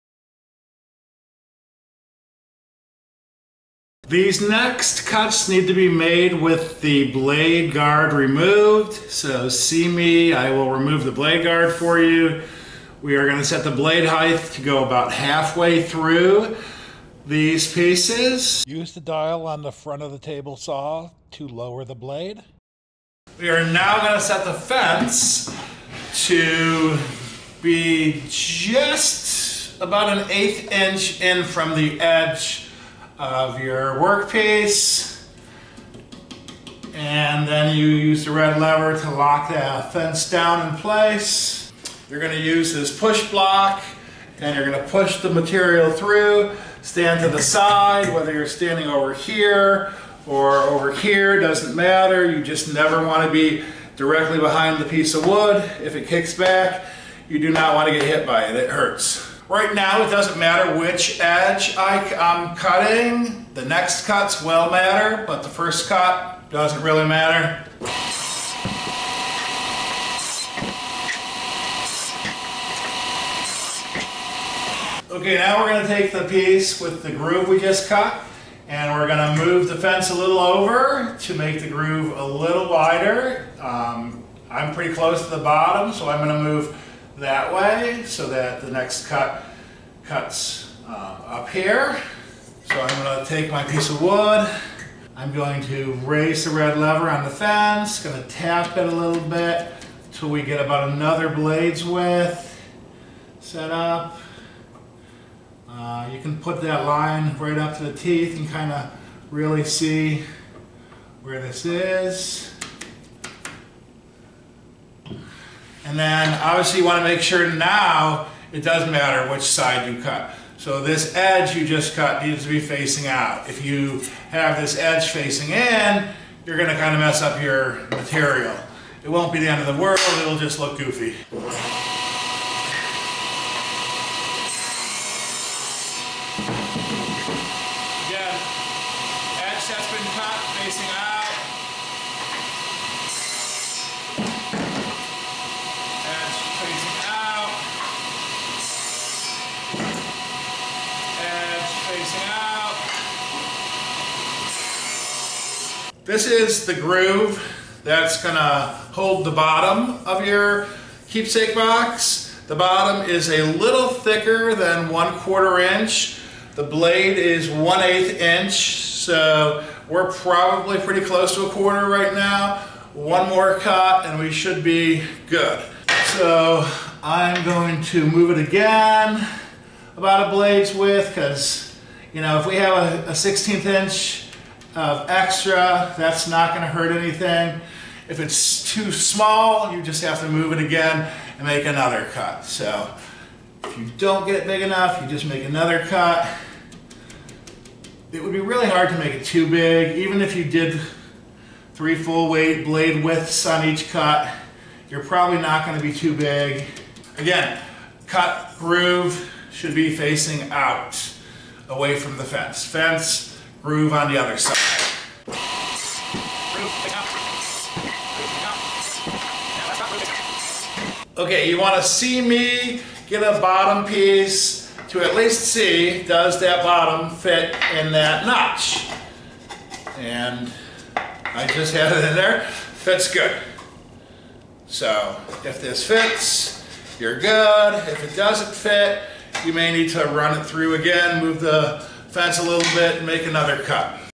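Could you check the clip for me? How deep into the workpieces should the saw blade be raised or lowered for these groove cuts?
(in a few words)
About halfway through.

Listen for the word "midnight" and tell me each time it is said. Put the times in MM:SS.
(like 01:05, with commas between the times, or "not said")
not said.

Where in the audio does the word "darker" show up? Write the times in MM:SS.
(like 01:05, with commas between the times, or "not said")
not said.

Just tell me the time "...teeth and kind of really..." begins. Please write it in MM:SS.
01:47.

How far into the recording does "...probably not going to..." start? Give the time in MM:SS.
03:25.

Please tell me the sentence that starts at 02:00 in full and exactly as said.
So this edge you just cut needs to be facing out.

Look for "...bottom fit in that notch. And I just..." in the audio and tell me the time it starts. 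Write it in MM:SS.
03:46.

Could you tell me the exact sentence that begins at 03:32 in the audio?
Fence groove on the other side.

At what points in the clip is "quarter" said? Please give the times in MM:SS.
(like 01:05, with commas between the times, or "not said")
02:45, 02:51.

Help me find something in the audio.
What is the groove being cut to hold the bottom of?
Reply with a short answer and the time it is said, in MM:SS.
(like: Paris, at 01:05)
Keepsake box, at 02:41.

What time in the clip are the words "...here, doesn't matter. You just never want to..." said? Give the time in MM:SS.
00:50.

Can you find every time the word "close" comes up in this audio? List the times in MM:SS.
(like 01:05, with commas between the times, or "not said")
01:24, 02:51.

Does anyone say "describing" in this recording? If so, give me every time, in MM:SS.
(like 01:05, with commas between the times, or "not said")
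not said.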